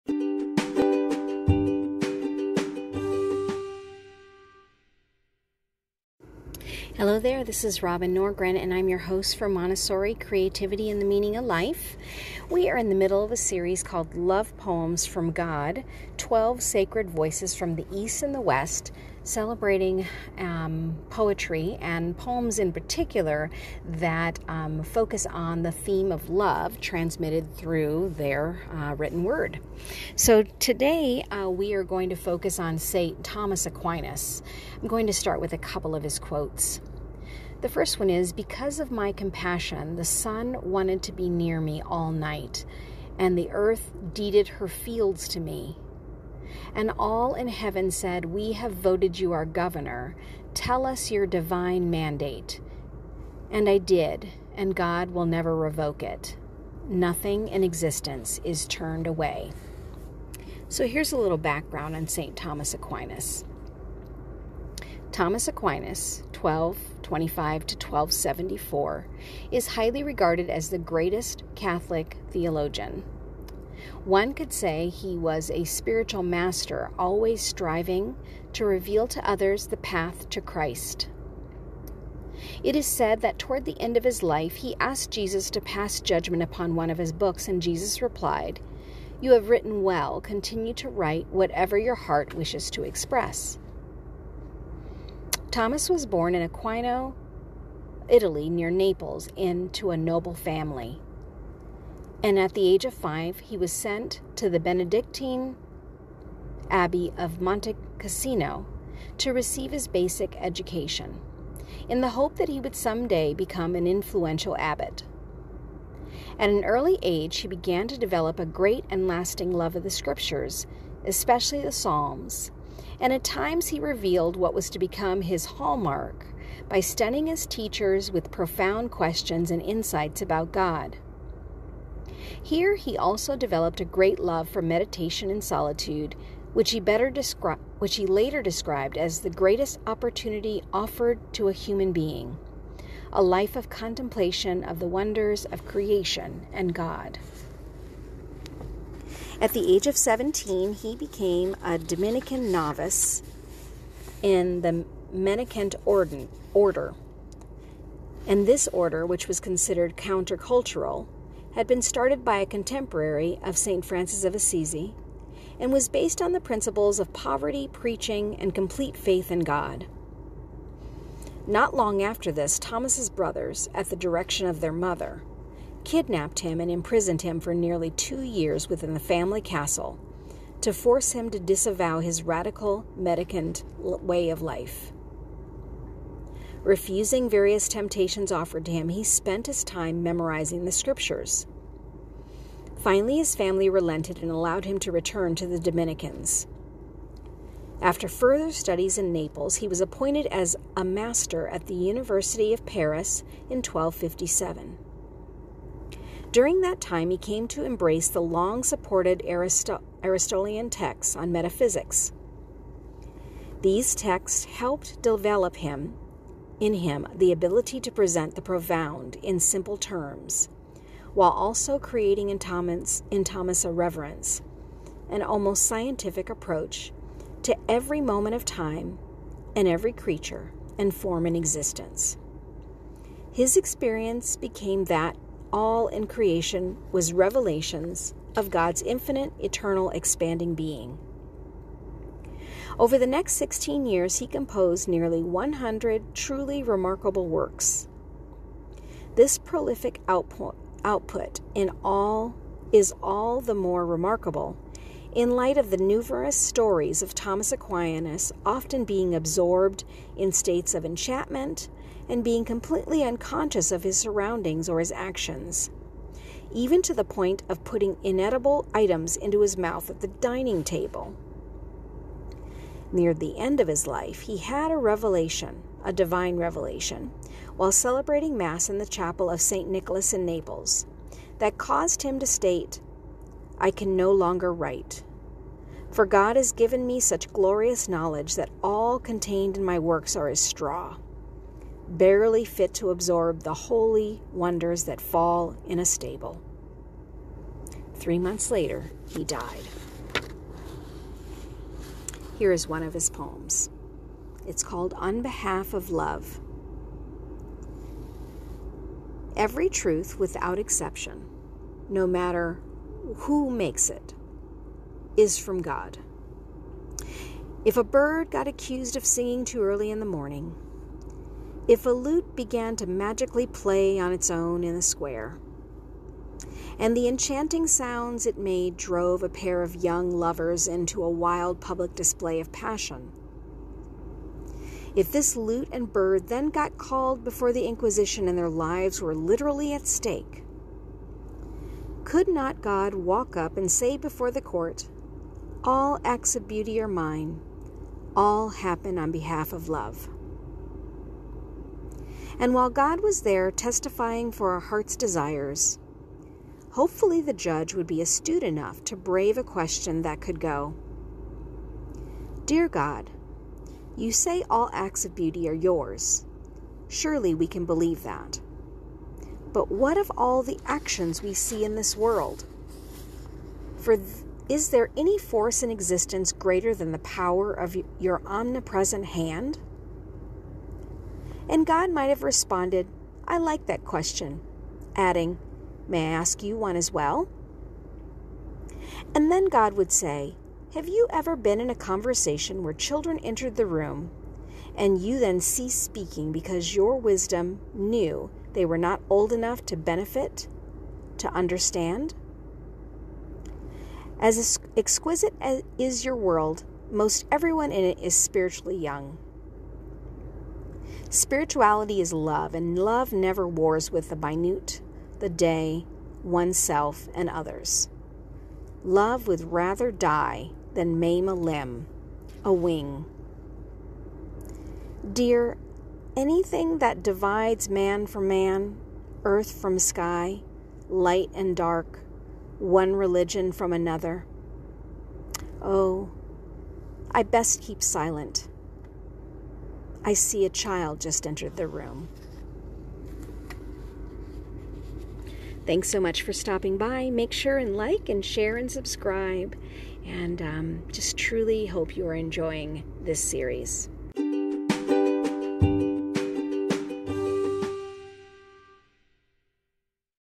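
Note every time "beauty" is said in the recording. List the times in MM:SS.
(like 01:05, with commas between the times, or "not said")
05:46, 06:05.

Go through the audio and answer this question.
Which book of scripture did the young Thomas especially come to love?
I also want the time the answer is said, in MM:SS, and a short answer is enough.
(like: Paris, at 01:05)
The Psalms, at 02:01.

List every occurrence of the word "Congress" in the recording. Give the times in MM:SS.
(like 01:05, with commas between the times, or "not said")
not said.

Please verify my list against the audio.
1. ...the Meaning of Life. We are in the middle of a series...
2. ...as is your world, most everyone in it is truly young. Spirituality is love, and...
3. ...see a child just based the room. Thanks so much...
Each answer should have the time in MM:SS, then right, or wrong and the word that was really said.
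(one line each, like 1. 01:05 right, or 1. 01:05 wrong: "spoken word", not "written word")
1. 00:11 right
2. 06:45 wrong: "spiritually", not "truly"
3. 07:20 wrong: "entered", not "based".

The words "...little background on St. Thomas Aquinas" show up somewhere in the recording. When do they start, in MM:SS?
01:01.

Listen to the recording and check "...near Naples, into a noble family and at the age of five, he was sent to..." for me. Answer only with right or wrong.
right.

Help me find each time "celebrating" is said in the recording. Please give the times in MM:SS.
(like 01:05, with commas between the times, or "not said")
00:19, 04:37.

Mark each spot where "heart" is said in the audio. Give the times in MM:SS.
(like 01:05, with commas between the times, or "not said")
01:31, 05:54.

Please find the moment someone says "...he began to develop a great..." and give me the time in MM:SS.
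01:57.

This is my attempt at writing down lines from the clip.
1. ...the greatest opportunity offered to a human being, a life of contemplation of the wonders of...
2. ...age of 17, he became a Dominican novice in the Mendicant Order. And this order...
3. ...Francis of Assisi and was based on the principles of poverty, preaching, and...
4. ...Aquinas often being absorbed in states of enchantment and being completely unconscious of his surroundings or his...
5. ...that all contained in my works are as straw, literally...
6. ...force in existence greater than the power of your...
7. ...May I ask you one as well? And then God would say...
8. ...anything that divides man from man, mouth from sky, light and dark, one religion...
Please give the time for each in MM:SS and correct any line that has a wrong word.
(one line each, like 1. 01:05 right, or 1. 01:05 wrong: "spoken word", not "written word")
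1. 02:19 right
2. 02:29 right
3. 02:43 right
4. 04:17 right
5. 04:48 wrong: "barely", not "literally"
6. 06:15 right
7. 06:25 right
8. 07:06 wrong: "earth", not "mouth".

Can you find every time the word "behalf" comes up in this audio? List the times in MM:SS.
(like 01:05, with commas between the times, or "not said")
05:05, 05:49.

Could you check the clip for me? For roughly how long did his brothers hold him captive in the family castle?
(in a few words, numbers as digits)
Nearly two years.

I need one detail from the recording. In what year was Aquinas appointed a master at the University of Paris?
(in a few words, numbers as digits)
1257.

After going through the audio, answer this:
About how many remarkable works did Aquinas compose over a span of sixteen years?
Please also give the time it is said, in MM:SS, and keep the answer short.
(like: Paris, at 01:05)
Nearly 100, at 04:04.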